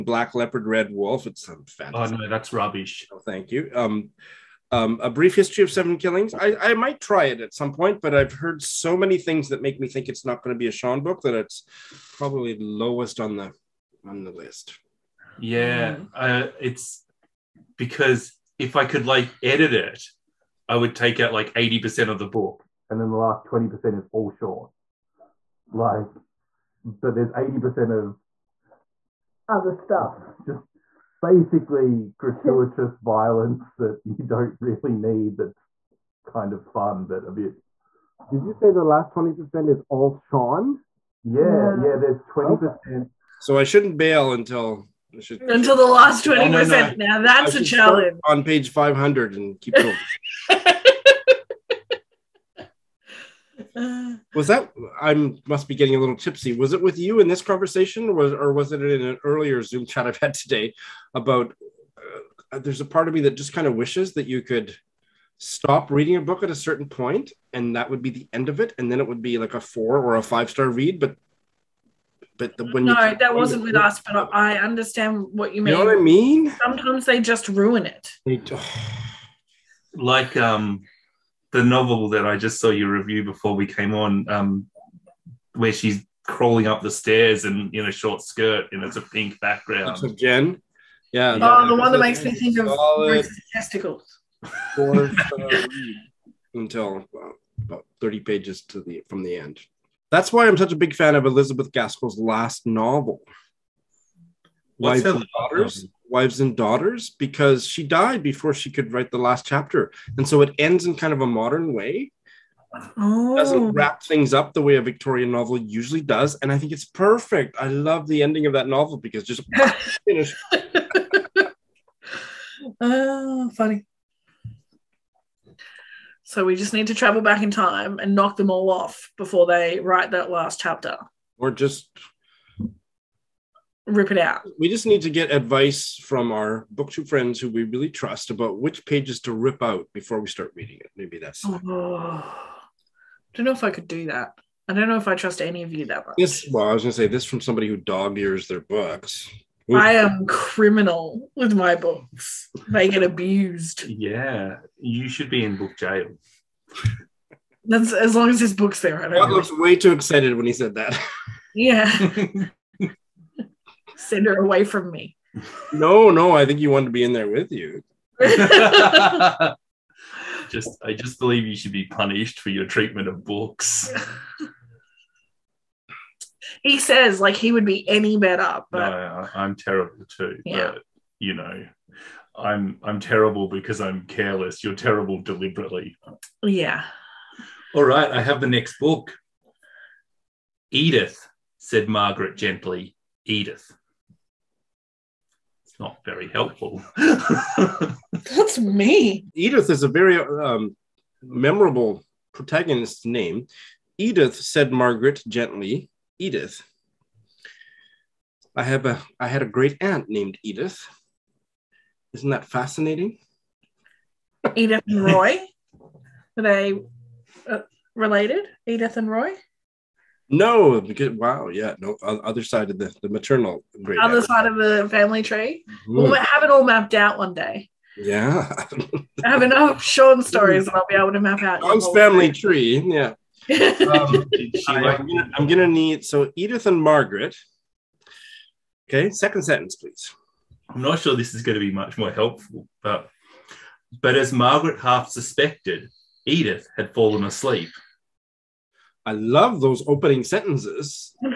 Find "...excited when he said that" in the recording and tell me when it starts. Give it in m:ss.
2:39.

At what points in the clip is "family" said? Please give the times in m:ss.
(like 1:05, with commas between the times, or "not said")
3:44, 3:51.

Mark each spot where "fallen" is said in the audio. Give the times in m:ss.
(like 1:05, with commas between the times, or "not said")
4:06.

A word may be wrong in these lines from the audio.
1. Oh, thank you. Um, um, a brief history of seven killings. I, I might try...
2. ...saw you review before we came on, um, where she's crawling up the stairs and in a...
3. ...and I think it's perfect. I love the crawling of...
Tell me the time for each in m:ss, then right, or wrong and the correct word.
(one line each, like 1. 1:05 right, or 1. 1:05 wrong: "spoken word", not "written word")
1. 0:03 right
2. 1:22 right
3. 1:56 wrong: "ending", not "crawling".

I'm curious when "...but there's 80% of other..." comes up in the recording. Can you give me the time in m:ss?
0:26.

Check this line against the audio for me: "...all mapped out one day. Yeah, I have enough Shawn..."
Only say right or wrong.
right.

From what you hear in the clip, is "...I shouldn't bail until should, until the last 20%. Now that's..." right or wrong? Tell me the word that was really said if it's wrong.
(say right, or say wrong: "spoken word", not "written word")
right.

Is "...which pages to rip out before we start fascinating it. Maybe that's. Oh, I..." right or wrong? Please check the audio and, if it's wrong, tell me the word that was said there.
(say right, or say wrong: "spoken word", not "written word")
wrong: "reading", not "fascinating".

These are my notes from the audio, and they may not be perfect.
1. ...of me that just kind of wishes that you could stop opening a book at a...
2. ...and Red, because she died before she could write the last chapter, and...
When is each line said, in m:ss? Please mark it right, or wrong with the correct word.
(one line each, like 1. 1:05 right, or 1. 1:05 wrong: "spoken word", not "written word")
1. 1:03 wrong: "reading", not "opening"
2. 1:46 wrong: "Daughters", not "Red".